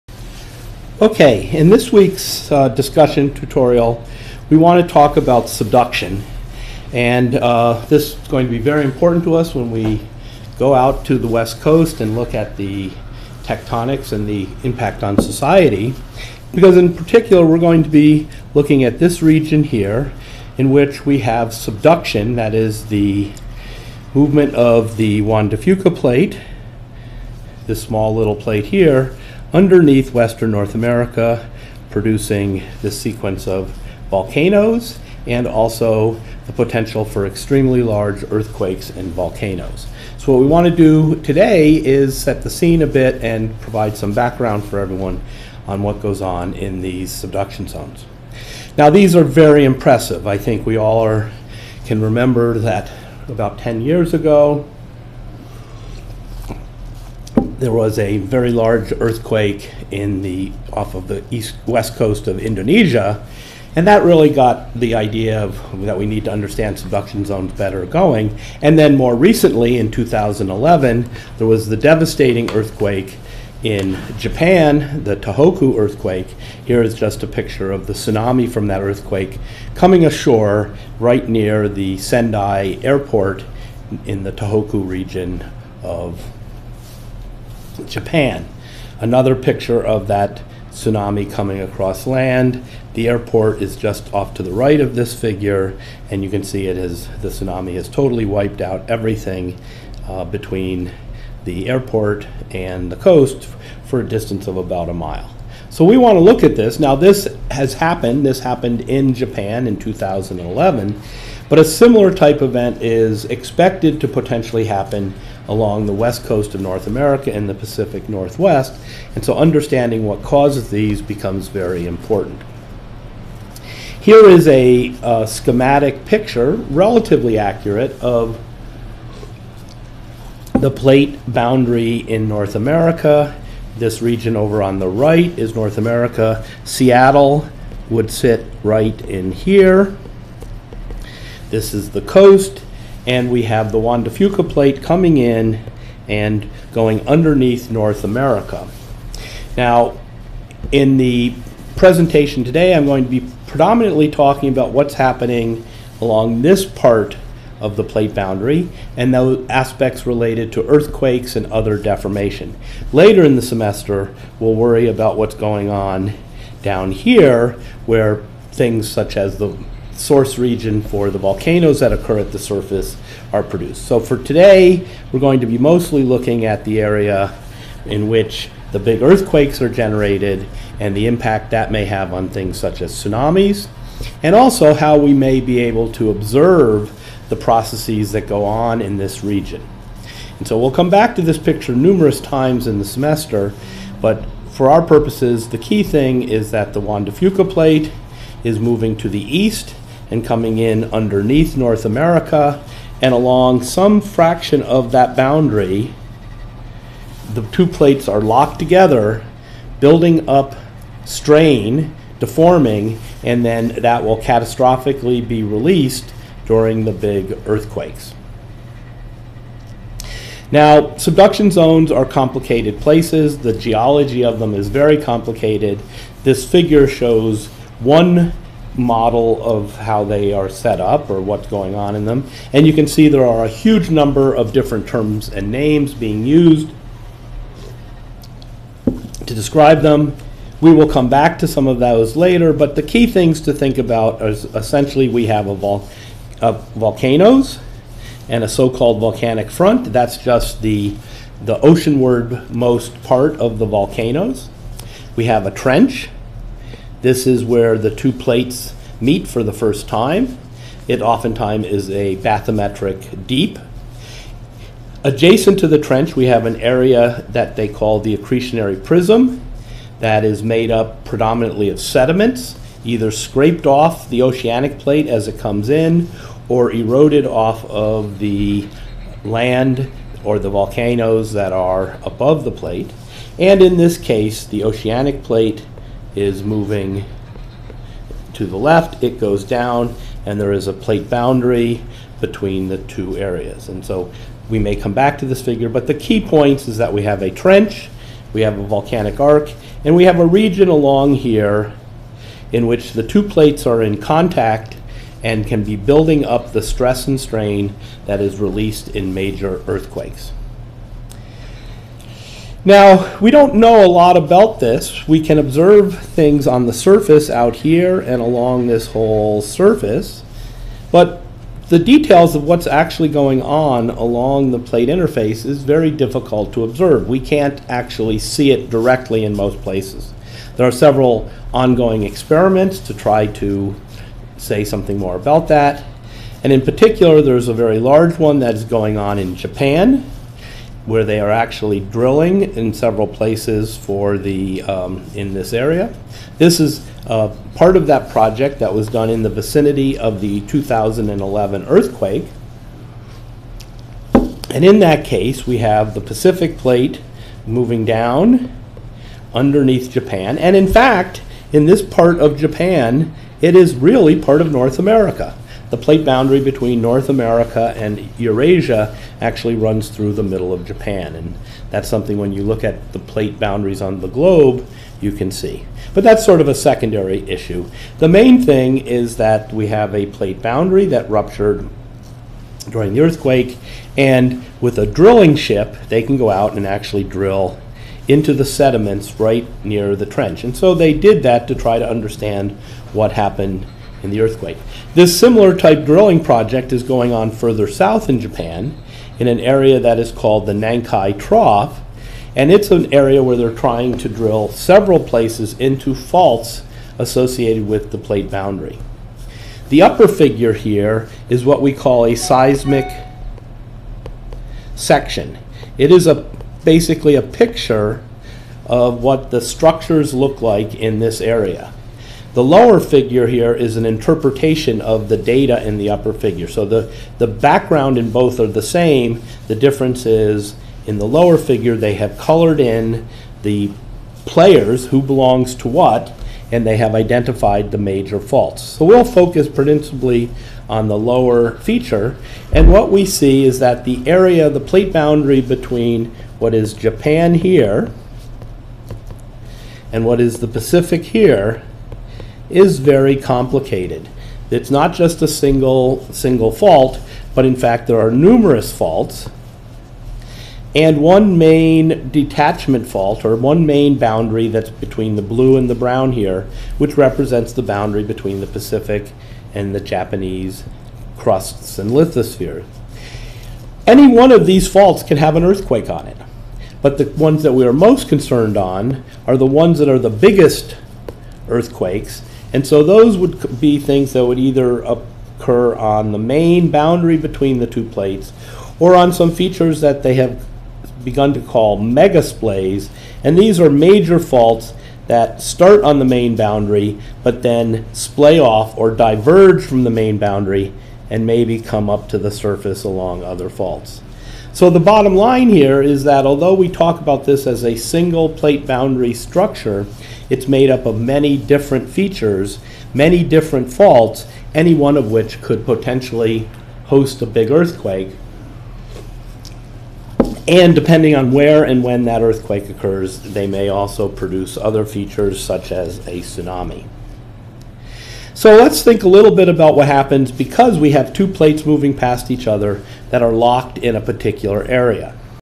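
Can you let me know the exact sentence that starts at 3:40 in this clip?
Now, subduction zones are complicated places.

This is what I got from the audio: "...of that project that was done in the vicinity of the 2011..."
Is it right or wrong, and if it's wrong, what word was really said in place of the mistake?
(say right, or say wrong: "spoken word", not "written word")
right.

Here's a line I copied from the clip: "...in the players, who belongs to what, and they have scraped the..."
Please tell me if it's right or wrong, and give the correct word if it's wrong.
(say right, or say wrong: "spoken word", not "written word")
wrong: "identified", not "scraped".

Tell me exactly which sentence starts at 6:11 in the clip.
And that's something when you look at the plate boundaries on the globe, you can see.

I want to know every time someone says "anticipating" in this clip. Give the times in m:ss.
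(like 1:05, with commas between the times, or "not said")
not said.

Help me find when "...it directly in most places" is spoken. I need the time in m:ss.
5:28.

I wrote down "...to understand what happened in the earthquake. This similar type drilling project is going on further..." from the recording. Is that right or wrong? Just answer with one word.
right.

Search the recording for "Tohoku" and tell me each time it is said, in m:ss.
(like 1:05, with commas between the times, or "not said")
1:15, 1:24.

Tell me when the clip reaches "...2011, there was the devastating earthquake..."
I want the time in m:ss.
1:09.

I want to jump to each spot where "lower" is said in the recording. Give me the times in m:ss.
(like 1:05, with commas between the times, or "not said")
7:02, 7:11, 7:20.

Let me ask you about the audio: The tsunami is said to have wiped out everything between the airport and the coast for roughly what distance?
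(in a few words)
About a mile.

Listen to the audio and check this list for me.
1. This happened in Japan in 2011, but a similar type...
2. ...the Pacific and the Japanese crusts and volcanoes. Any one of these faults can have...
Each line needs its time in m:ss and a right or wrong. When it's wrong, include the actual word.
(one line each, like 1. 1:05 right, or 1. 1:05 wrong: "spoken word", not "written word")
1. 1:48 right
2. 7:48 wrong: "lithospheres", not "volcanoes".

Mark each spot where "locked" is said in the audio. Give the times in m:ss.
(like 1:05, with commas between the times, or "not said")
3:28, 8:53.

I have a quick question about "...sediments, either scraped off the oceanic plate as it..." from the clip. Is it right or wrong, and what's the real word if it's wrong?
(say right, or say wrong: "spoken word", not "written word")
right.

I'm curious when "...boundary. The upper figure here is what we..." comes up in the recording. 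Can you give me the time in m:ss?
6:48.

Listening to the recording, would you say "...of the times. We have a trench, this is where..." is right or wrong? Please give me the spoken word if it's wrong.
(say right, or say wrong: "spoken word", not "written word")
wrong: "volcanoes", not "times".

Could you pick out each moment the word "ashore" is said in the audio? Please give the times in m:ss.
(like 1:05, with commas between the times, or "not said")
1:20.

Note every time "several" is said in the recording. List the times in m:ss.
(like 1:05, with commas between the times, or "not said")
5:30, 5:42, 6:44.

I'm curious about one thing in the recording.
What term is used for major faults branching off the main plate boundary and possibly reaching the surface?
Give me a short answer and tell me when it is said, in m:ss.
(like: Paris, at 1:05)
Megasplays, at 8:11.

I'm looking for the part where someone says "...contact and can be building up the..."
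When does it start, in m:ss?
5:03.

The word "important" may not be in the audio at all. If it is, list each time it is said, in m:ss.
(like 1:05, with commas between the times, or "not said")
0:08, 2:01.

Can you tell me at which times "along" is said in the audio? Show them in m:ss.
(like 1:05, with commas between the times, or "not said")
1:55, 2:35, 3:23, 5:00, 5:18, 5:23, 8:22.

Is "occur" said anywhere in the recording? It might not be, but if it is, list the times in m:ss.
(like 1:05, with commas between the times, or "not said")
2:51, 8:04, 8:42.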